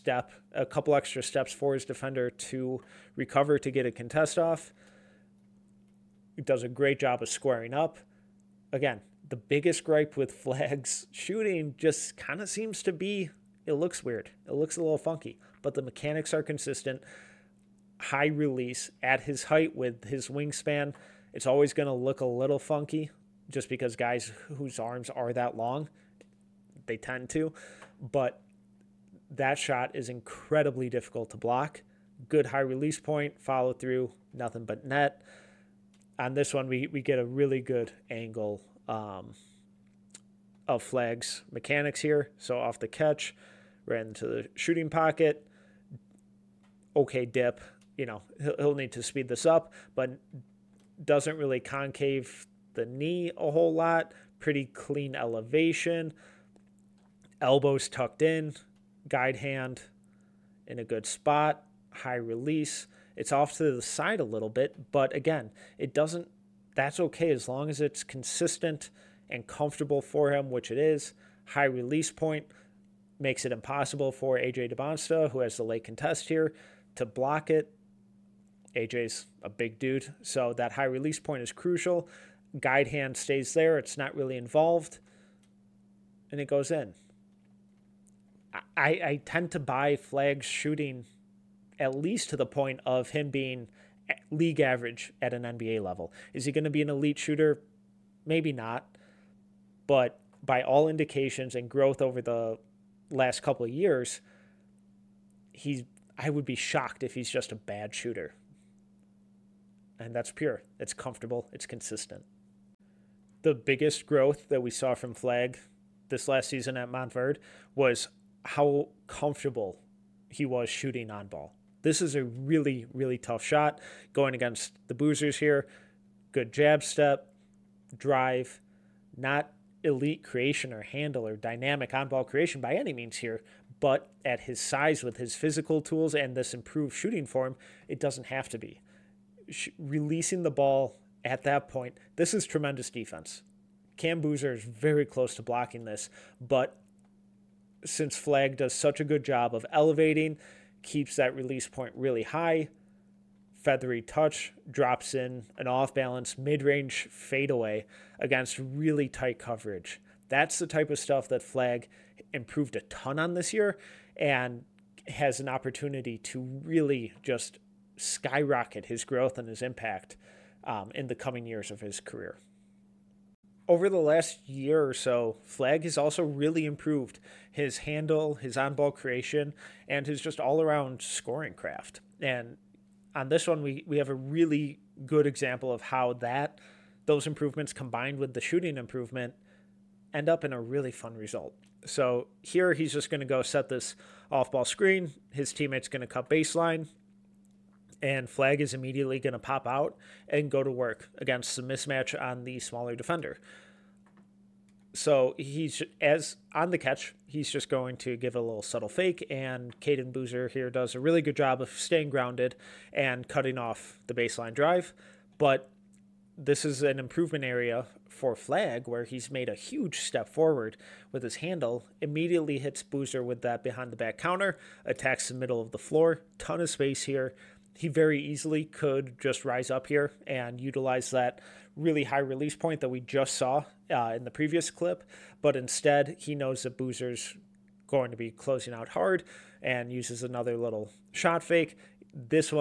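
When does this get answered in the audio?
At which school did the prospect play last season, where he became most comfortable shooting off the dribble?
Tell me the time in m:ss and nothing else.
1:56.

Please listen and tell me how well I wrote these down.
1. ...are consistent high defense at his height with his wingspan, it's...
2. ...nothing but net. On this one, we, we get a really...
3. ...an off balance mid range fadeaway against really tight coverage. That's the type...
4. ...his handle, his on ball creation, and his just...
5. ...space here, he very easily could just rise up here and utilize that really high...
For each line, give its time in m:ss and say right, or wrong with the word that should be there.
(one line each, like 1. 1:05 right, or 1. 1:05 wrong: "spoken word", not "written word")
1. 0:16 wrong: "release", not "defense"
2. 0:34 right
3. 2:35 right
4. 2:57 right
5. 3:46 right.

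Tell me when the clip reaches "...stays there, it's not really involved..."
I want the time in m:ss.
1:23.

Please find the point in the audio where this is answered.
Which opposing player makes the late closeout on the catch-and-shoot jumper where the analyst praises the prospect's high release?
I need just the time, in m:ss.
1:14.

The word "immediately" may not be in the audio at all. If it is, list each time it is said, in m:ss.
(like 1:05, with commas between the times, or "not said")
3:18, 3:41.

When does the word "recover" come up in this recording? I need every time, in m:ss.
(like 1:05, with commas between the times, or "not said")
0:03.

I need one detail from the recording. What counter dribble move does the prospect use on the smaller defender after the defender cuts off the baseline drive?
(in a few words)
behind the back.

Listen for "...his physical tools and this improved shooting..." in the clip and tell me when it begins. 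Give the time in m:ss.
2:15.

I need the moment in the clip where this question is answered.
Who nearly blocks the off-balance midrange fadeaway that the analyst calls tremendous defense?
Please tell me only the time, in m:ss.
2:23.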